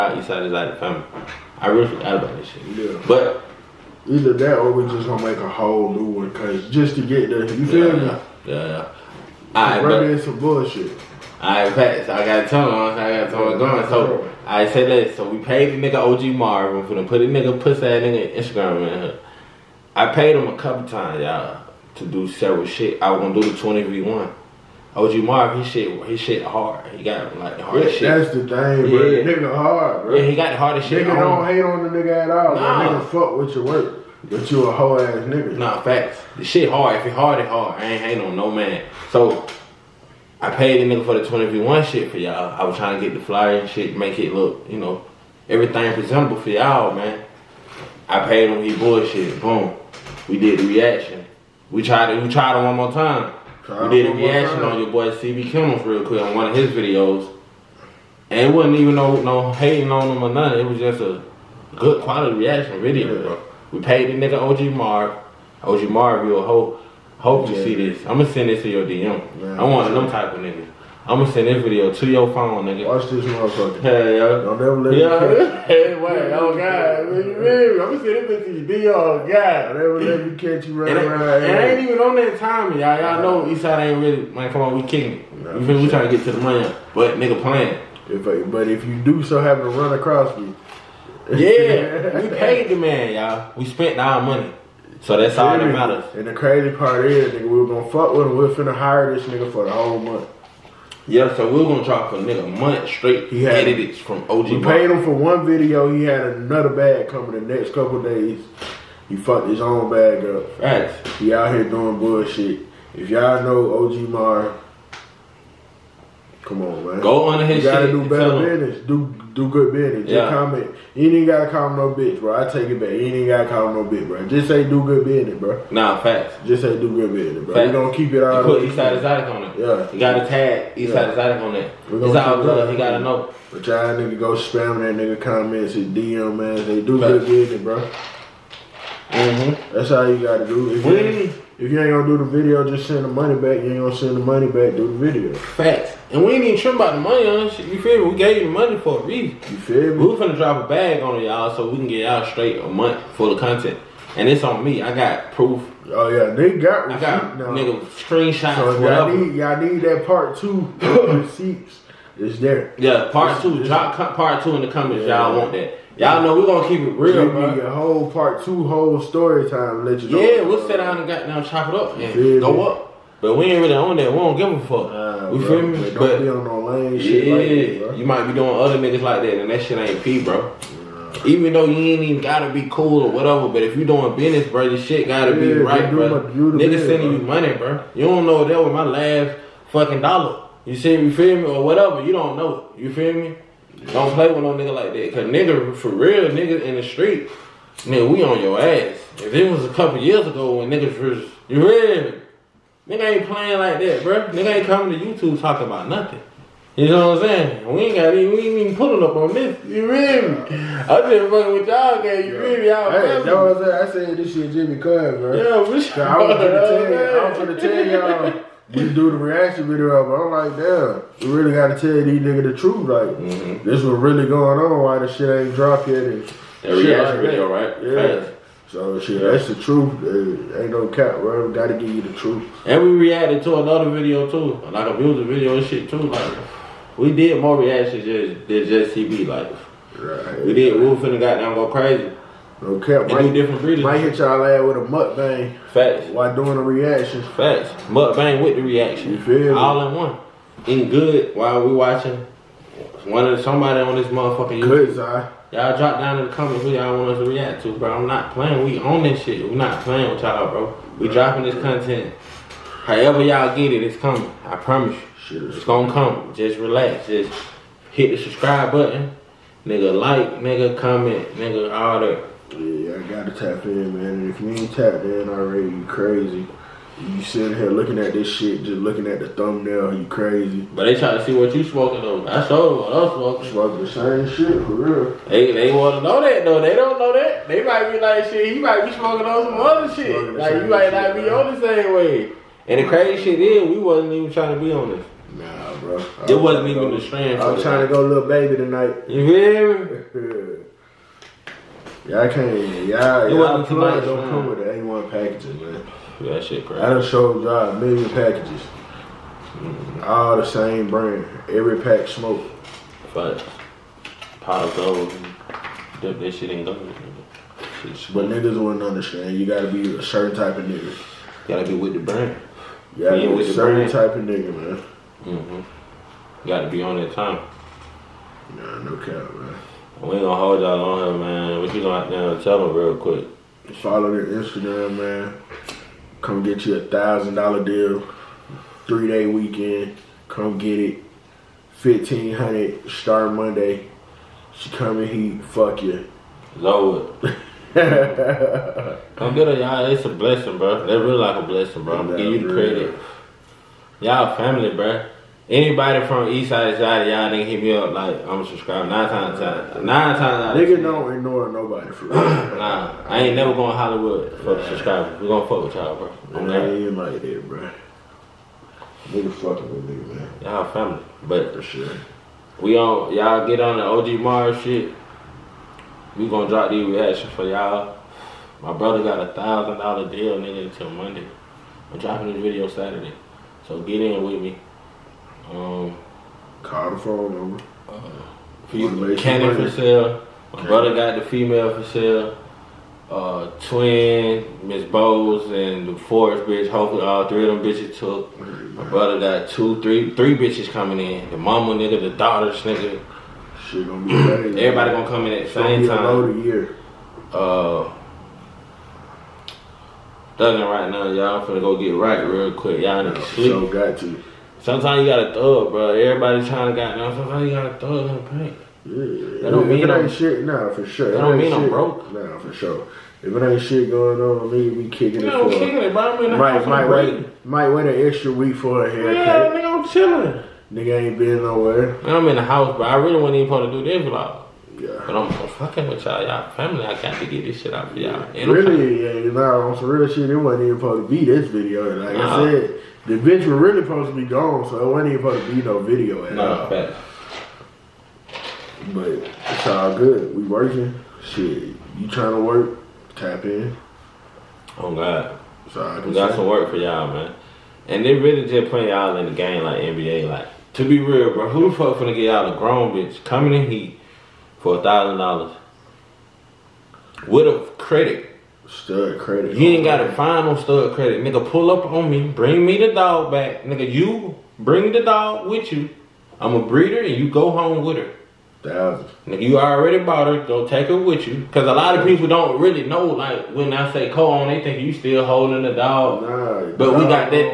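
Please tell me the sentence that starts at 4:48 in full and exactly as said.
He might be smoking on some other shit.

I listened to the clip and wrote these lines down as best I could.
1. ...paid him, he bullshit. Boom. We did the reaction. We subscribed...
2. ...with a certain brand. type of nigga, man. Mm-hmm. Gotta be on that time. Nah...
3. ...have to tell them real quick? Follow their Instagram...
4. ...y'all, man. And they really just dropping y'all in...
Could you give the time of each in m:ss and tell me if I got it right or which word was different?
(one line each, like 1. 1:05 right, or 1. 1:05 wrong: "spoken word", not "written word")
1. 0:48 wrong: "tried", not "subscribed"
2. 5:23 right
3. 5:32 right
4. 7:36 wrong: "putting", not "dropping".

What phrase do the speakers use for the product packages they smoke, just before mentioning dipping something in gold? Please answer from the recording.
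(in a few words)
Pot of gold.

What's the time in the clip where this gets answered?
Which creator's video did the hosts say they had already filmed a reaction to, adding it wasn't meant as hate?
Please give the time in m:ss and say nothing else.
0:55.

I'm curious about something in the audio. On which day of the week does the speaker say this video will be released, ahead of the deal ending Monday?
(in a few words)
Saturday.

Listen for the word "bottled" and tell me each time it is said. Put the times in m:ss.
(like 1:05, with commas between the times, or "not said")
not said.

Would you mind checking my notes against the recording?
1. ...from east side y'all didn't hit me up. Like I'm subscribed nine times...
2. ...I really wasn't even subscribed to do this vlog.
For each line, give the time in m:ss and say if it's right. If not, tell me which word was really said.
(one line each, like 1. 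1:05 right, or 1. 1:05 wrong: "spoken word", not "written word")
1. 5:56 right
2. 7:12 wrong: "supposed", not "subscribed".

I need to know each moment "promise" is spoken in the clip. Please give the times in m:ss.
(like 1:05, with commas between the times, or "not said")
4:24.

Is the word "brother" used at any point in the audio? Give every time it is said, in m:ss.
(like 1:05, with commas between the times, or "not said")
6:18, 6:30, 6:38.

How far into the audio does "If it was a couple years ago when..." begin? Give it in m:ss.
3:19.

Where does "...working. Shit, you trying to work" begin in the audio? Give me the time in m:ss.
7:30.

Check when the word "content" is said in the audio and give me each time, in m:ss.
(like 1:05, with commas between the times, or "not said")
2:33, 4:21.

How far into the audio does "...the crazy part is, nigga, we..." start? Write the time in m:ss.
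1:36.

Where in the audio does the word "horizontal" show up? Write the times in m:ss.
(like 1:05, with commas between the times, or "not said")
not said.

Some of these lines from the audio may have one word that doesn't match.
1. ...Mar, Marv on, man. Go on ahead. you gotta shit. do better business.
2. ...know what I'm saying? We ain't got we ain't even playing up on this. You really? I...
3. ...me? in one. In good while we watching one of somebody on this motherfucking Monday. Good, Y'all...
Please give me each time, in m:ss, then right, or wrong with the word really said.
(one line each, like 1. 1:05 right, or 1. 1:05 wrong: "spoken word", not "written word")
1. 1:54 wrong: "Come", not "Marv"
2. 3:26 wrong: "pulling", not "playing"
3. 4:09 wrong: "YouTube", not "Monday".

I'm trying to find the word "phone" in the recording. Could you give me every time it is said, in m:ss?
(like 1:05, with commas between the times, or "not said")
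1:12, 6:26.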